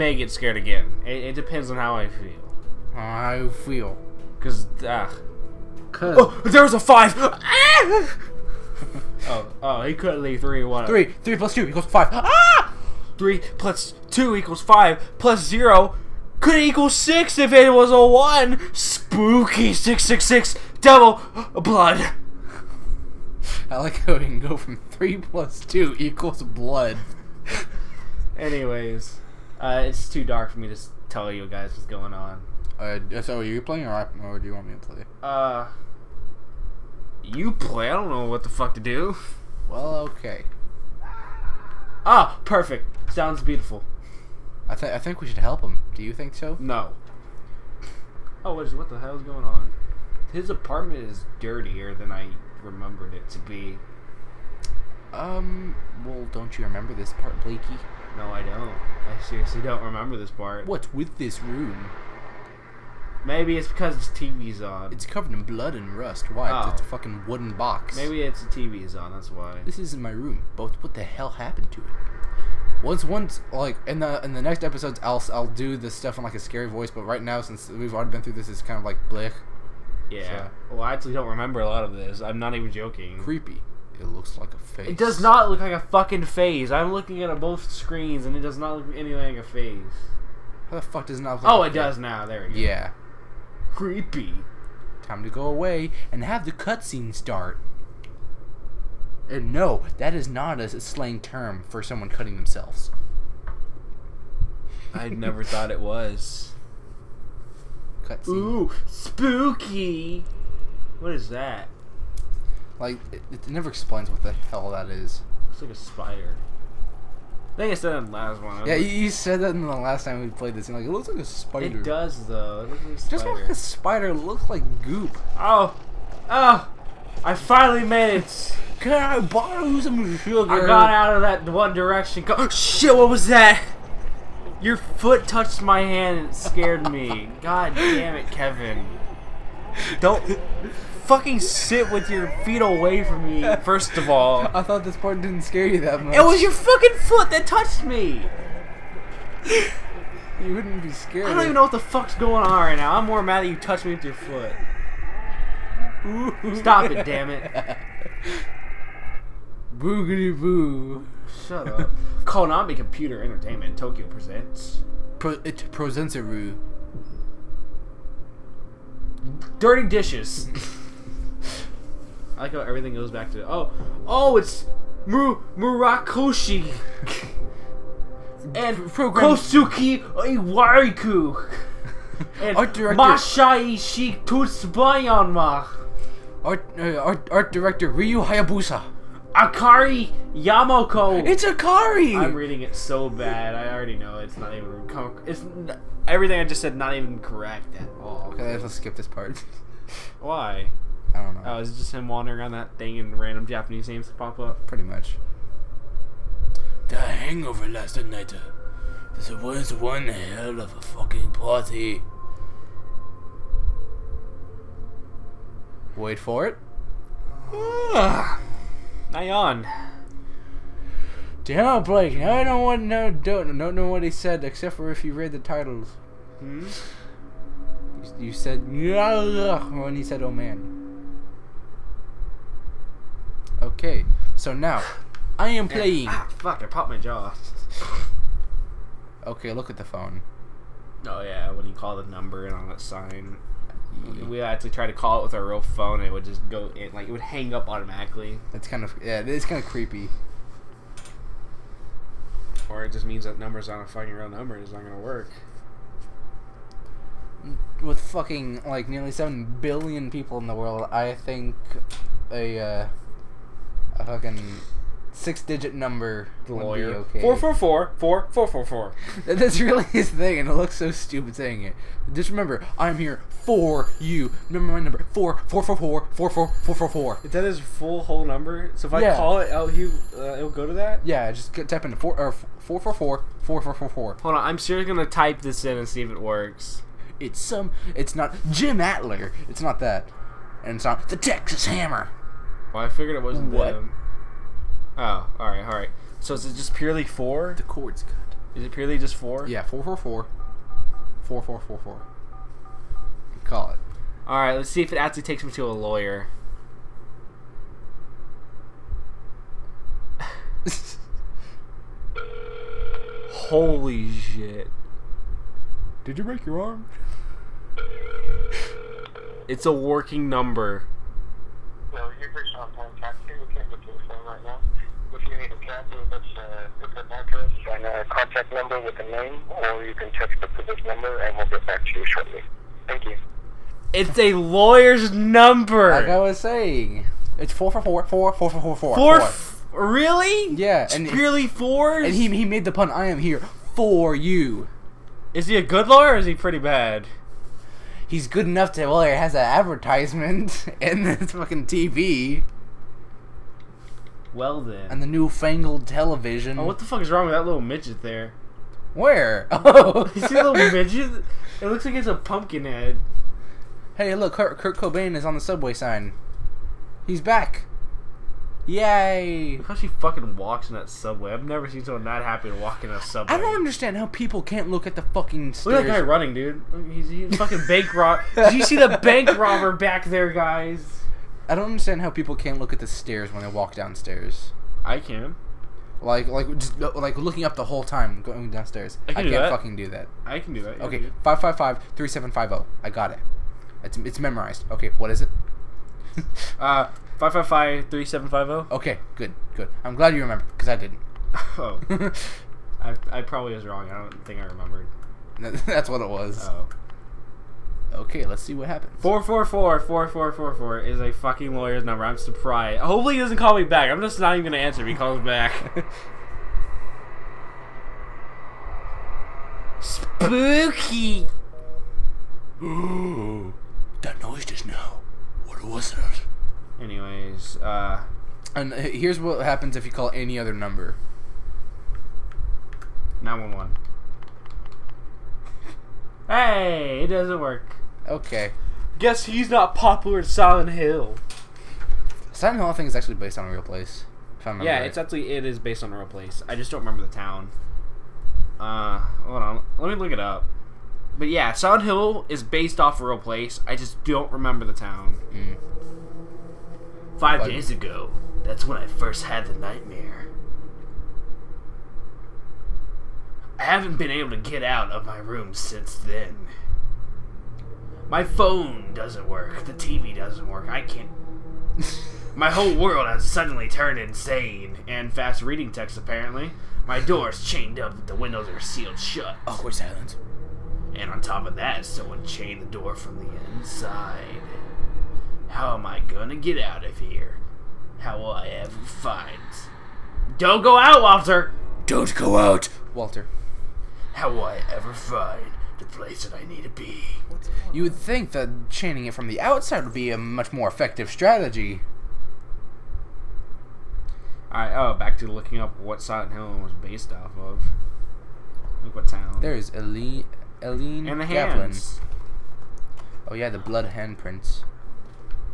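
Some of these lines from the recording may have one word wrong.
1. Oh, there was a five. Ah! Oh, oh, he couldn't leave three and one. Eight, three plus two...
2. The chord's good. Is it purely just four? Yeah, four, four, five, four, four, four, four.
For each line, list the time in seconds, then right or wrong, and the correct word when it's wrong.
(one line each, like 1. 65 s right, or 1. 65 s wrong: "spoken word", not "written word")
1. 6 s wrong: "Three", not "Eight"
2. 297 s wrong: "four", not "five".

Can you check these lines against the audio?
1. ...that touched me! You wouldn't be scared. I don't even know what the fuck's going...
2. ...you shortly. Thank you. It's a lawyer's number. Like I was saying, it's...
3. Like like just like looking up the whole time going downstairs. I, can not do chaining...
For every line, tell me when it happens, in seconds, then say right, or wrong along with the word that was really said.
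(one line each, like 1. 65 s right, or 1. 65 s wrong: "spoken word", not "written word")
1. 147 s right
2. 331 s right
3. 386 s wrong: "fucking", not "chaining".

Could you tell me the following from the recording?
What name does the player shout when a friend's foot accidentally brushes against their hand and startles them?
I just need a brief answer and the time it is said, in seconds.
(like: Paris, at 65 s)
Kevin, at 138 s.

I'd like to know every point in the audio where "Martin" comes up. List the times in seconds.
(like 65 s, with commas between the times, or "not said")
not said.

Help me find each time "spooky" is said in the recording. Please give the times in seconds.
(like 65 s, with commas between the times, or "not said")
18 s, 108 s, 419 s.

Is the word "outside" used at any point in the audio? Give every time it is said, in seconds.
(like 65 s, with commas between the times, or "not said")
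499 s.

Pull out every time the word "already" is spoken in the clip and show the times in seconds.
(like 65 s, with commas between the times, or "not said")
77 s, 193 s.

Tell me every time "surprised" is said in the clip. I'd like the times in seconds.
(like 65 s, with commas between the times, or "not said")
412 s.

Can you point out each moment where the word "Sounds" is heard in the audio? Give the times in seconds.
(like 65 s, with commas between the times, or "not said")
43 s.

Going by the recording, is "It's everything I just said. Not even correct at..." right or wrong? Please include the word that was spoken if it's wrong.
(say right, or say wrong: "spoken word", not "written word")
right.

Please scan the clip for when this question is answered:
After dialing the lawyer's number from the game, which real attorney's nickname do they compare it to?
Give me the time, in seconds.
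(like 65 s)
291 s.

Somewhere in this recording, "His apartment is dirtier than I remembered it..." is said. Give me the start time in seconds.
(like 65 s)
50 s.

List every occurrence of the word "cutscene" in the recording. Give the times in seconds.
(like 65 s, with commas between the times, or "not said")
96 s, 108 s.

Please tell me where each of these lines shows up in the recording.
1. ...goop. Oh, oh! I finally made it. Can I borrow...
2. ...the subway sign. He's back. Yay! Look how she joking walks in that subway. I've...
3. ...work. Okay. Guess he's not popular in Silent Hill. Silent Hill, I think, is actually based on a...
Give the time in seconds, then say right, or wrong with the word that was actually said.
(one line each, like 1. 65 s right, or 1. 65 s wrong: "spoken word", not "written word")
1. 124 s right
2. 365 s wrong: "fucking", not "joking"
3. 437 s right.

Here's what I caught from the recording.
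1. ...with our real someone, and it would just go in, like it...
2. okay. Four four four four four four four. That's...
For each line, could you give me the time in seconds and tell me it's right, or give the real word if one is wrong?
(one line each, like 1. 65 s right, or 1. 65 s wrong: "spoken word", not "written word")
1. 245 s wrong: "phone", not "someone"
2. 266 s right.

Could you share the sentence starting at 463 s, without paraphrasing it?
haven't been able to get out of my room since then.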